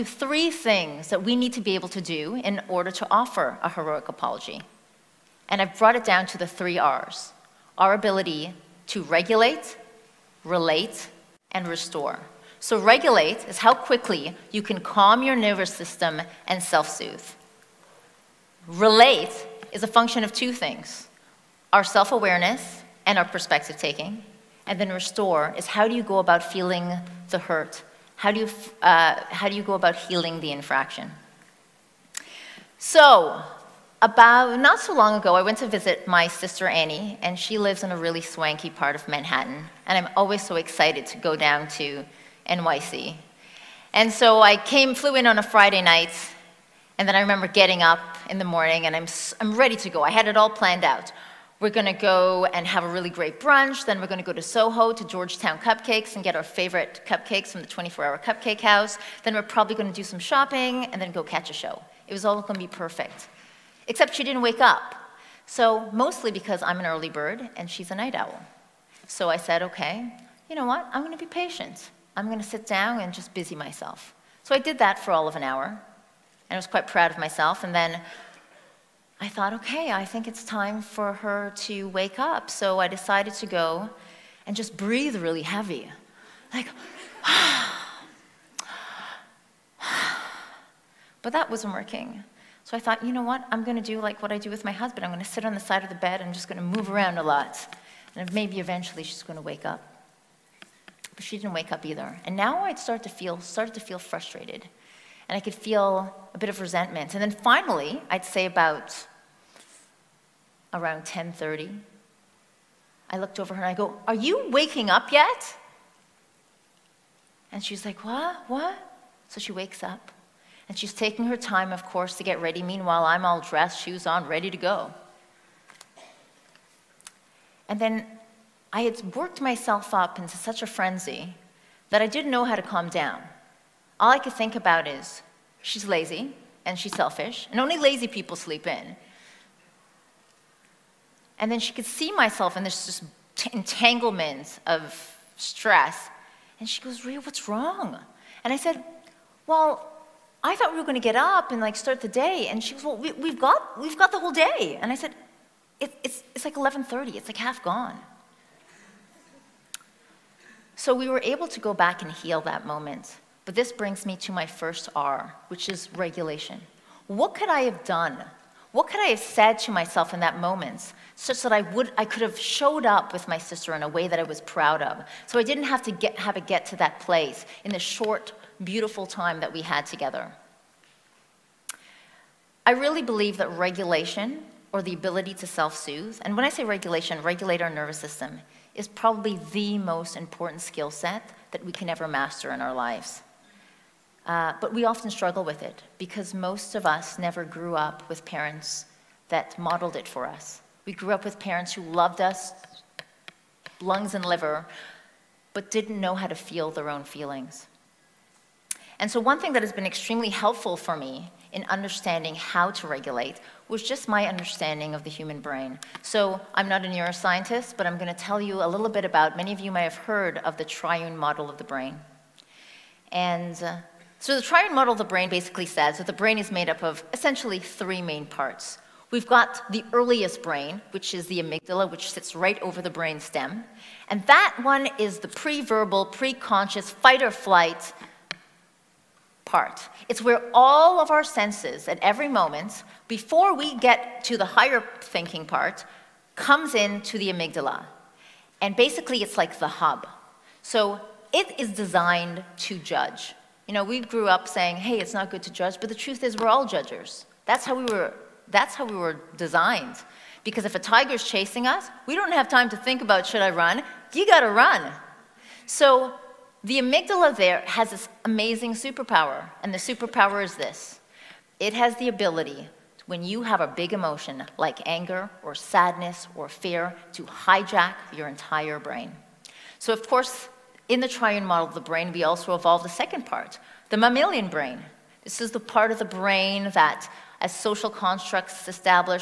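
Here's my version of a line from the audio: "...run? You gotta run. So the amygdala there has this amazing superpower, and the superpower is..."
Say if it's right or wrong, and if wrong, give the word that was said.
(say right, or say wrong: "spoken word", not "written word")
right.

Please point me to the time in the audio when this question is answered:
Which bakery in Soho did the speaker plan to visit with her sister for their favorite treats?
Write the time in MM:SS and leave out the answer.
00:55.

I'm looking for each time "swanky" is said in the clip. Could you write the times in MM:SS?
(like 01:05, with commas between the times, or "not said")
00:38.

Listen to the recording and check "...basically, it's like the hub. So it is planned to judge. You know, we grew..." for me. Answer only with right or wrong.
wrong.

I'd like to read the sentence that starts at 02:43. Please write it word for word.
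But this brings me to my first R, which is regulation.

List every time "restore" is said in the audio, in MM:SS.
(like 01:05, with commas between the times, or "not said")
00:11, 00:24.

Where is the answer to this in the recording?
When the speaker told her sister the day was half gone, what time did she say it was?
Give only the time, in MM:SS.
02:36.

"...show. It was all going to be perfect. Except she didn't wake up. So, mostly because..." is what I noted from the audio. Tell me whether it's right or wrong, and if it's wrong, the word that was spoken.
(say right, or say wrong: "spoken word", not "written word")
right.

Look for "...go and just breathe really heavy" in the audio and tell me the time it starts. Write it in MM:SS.
01:23.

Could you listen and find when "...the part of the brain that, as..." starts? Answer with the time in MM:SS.
04:45.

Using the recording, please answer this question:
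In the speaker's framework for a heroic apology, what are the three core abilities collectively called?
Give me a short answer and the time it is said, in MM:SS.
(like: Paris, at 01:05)
the three R's, at 00:06.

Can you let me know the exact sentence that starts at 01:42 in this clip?
And now I'd start to feel, started to feel frustrated.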